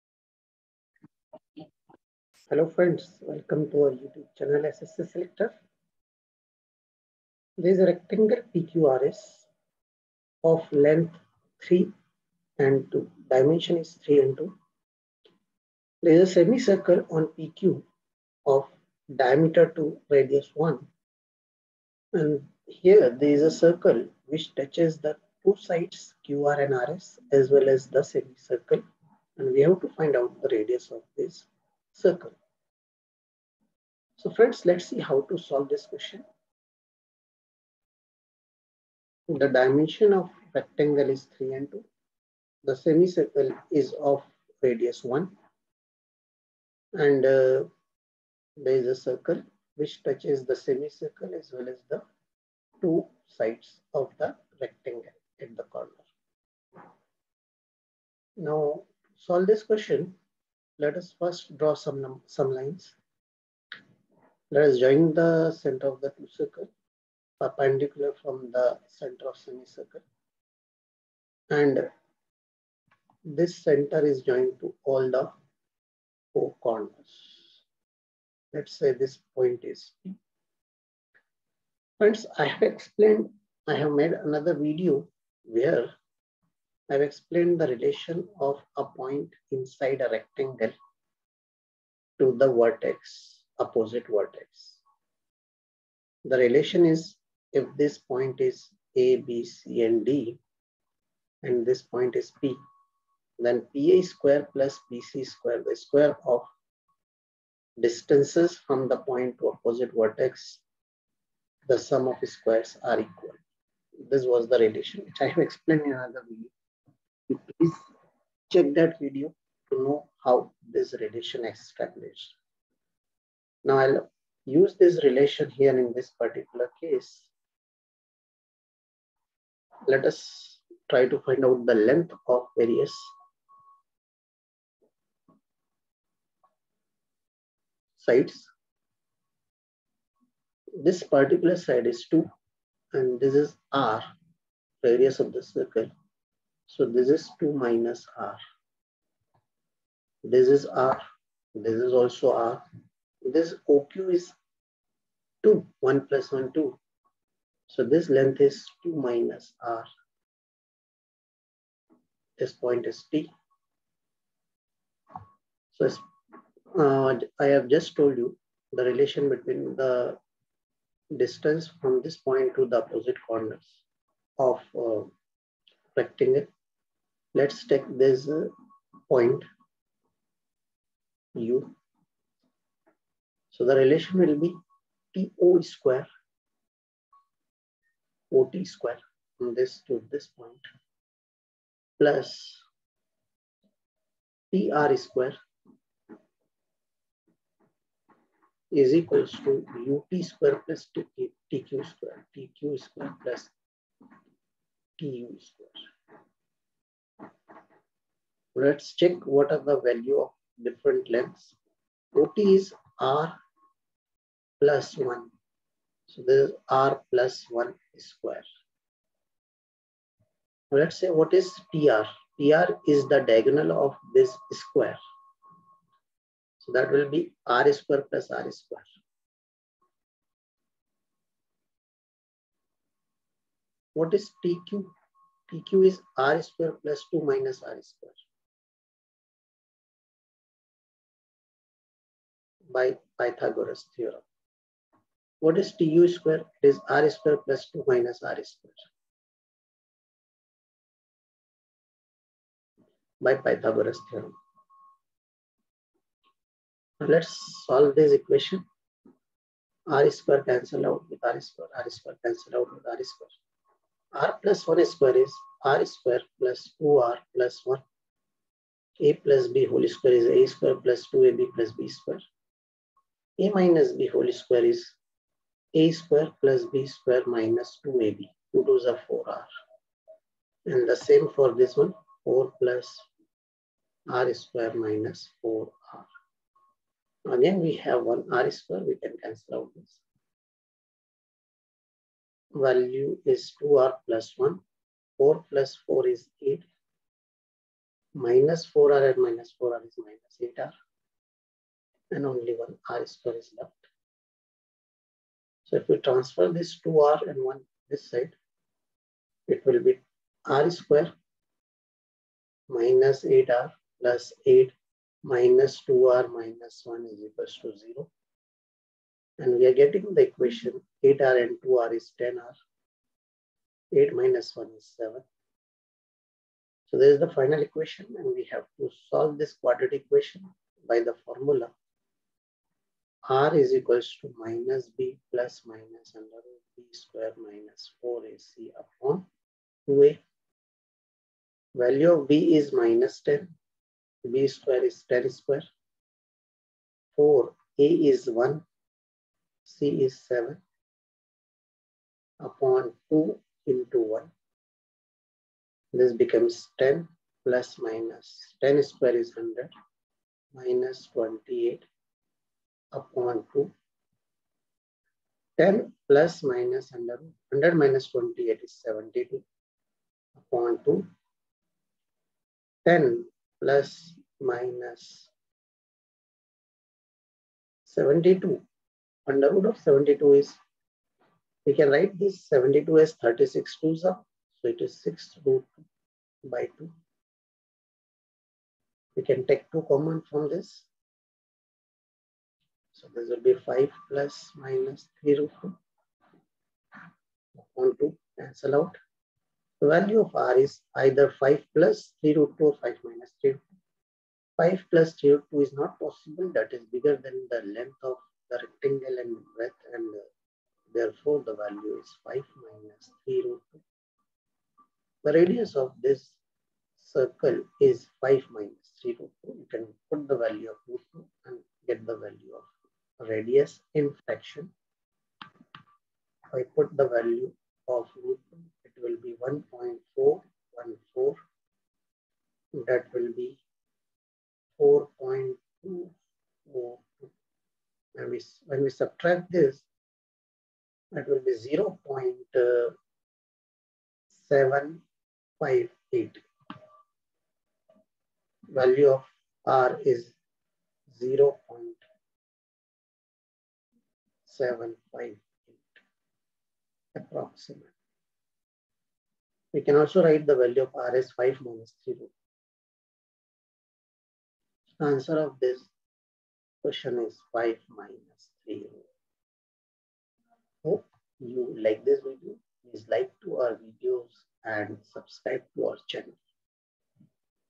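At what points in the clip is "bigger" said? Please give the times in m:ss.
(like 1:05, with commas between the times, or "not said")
6:46.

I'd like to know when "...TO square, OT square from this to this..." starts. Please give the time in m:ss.
3:05.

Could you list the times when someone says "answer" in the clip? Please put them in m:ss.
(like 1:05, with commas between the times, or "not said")
7:45.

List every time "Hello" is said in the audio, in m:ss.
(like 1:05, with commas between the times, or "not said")
0:02.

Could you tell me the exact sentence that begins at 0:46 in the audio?
And uh, there is a circle which touches the semicircle as well as the two sides of the rectangle at the corner.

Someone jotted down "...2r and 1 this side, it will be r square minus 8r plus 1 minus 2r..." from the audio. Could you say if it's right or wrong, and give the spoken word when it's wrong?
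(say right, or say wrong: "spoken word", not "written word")
wrong: "8", not "1".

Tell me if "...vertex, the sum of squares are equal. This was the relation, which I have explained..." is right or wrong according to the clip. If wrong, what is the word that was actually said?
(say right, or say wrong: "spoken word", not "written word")
right.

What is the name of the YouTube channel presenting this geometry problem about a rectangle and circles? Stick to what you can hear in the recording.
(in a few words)
SSC Selector.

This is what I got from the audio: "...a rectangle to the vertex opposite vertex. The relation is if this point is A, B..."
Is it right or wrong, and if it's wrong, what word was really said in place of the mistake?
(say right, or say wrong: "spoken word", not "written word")
right.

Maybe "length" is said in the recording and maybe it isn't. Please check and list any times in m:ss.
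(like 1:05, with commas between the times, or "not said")
0:10, 2:11, 2:38, 3:31, 6:47.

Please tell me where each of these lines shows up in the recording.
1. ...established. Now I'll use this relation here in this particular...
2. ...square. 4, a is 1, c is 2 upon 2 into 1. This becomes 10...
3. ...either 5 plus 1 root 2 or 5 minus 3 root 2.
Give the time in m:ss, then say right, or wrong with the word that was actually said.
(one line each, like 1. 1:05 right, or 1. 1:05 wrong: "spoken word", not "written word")
1. 2:01 right
2. 5:45 wrong: "7", not "2"
3. 6:41 wrong: "3", not "1".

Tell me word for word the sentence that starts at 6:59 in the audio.
You can put the value of radius in fraction.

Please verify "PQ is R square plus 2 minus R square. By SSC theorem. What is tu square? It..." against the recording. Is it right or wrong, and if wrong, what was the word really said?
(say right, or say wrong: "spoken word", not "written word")
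wrong: "Pythagoras", not "SSC".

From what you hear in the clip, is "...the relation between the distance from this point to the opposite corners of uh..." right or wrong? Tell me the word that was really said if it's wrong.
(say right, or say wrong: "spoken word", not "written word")
right.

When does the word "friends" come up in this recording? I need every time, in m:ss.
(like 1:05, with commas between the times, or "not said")
0:02, 0:34, 1:21.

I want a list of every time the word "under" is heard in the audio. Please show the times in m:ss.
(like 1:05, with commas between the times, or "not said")
5:36, 6:06, 6:19.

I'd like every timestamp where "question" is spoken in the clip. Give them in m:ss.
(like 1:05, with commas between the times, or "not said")
0:35, 0:59, 7:46.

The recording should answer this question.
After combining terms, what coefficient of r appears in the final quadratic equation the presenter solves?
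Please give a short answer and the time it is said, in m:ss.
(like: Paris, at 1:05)
10, at 5:21.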